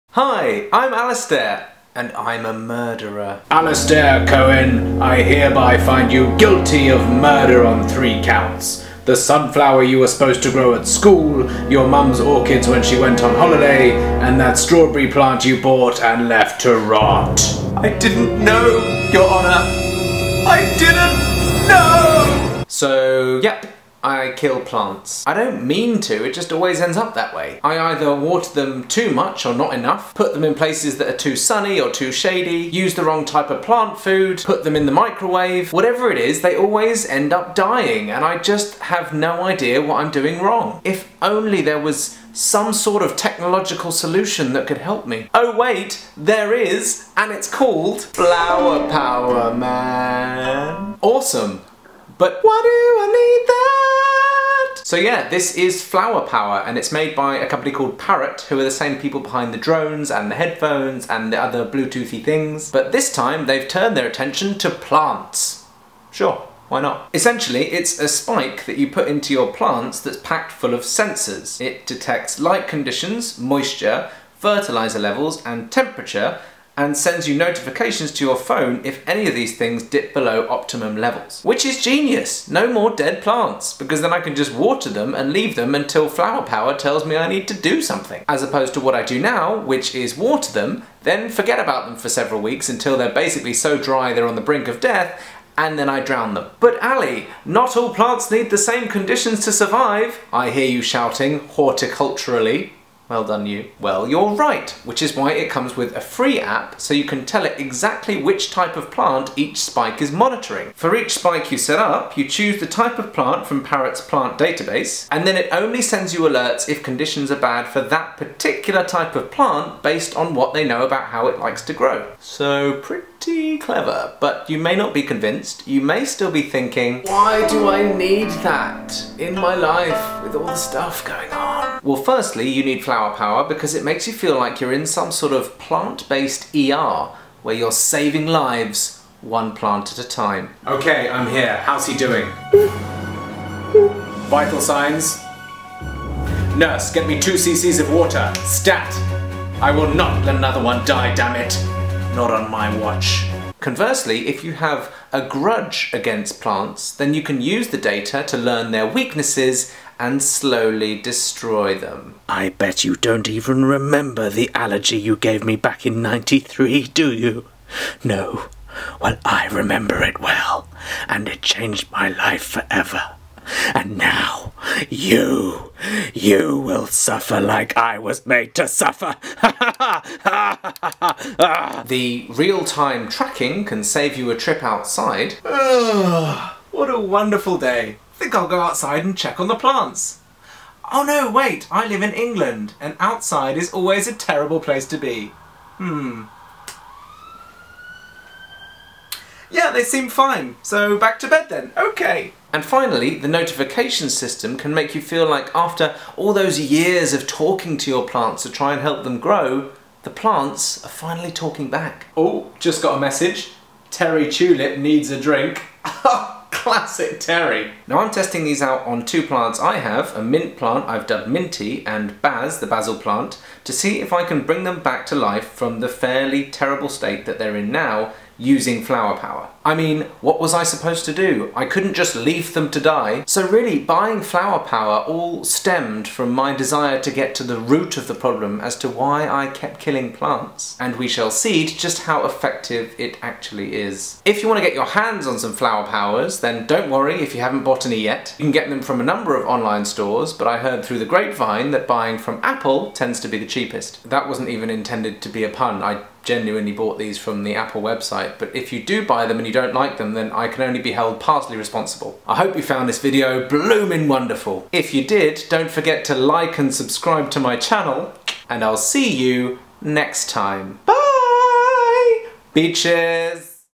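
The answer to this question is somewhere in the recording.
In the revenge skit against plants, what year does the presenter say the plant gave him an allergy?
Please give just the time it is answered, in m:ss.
2:46.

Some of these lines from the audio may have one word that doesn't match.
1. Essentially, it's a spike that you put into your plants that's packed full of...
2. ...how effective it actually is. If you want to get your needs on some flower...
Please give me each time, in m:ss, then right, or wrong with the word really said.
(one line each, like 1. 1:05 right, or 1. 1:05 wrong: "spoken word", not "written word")
1. 1:07 right
2. 4:02 wrong: "hands", not "needs".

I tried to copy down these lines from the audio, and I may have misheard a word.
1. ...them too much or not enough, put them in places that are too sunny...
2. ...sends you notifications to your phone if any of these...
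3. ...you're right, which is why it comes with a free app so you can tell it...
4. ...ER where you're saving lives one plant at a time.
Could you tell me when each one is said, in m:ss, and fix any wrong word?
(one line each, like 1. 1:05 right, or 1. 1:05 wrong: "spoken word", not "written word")
1. 0:28 right
2. 1:16 right
3. 1:44 right
4. 2:16 right.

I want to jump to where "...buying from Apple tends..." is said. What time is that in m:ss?
4:11.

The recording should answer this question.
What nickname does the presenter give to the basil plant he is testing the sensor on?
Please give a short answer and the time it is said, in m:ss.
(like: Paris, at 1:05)
Baz, at 3:42.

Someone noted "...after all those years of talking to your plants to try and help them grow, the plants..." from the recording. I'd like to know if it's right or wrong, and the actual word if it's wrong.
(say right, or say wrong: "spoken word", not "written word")
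right.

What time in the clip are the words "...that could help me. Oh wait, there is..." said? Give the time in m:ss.
0:44.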